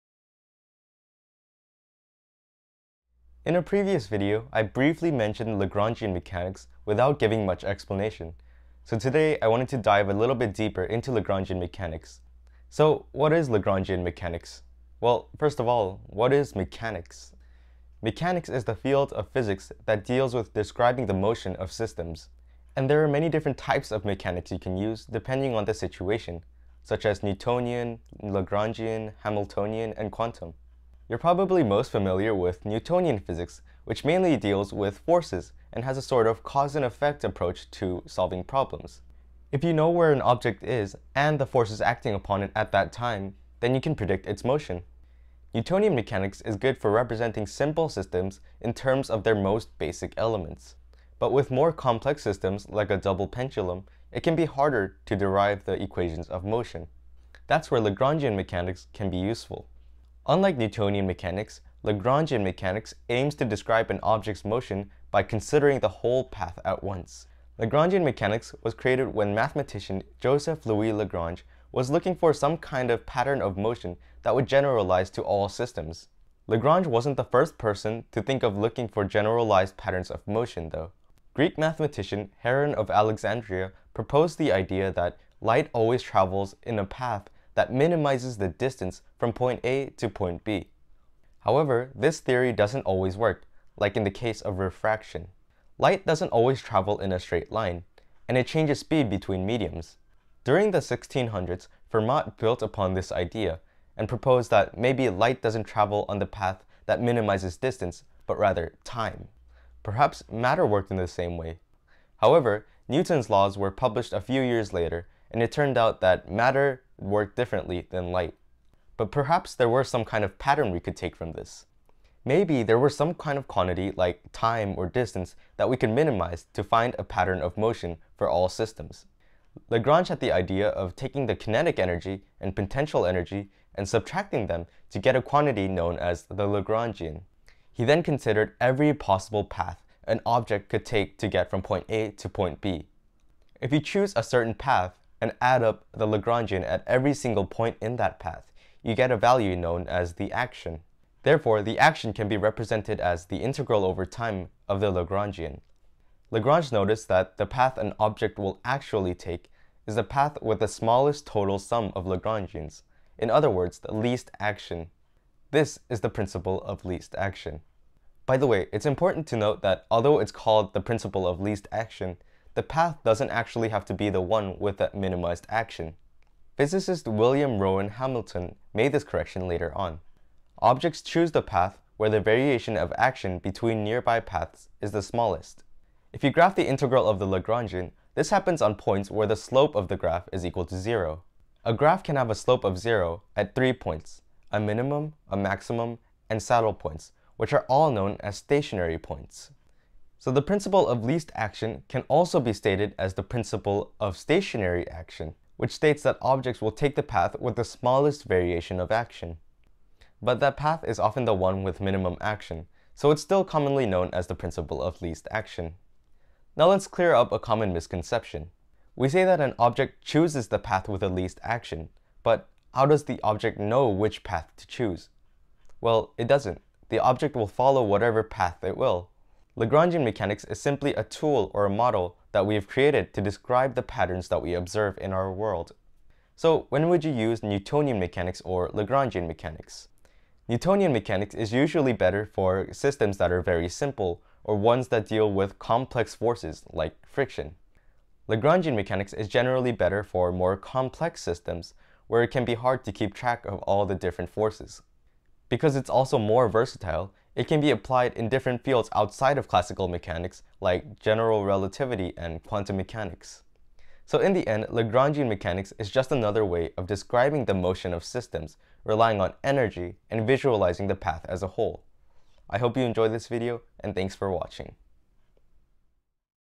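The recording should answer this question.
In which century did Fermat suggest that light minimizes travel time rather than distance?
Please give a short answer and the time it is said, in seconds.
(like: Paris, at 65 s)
1600s, at 100 s.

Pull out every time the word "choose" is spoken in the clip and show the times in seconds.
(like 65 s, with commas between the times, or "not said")
143 s, 181 s, 220 s, 224 s.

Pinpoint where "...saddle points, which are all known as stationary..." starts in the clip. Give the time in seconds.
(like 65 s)
196 s.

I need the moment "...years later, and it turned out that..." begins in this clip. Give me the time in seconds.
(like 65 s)
114 s.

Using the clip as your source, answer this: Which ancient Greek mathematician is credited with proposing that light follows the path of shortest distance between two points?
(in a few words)
Heron of Alexandria.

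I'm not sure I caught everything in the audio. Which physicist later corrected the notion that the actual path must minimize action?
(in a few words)
William Rowan Hamilton.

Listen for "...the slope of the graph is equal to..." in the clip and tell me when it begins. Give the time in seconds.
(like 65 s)
189 s.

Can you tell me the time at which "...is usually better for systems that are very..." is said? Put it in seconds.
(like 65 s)
241 s.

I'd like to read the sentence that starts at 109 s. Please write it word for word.
Perhaps matter worked in the same way.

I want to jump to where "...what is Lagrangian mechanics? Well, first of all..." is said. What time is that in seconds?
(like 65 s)
13 s.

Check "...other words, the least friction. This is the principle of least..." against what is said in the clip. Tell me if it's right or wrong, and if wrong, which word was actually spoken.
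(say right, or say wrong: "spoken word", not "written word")
wrong: "action", not "friction".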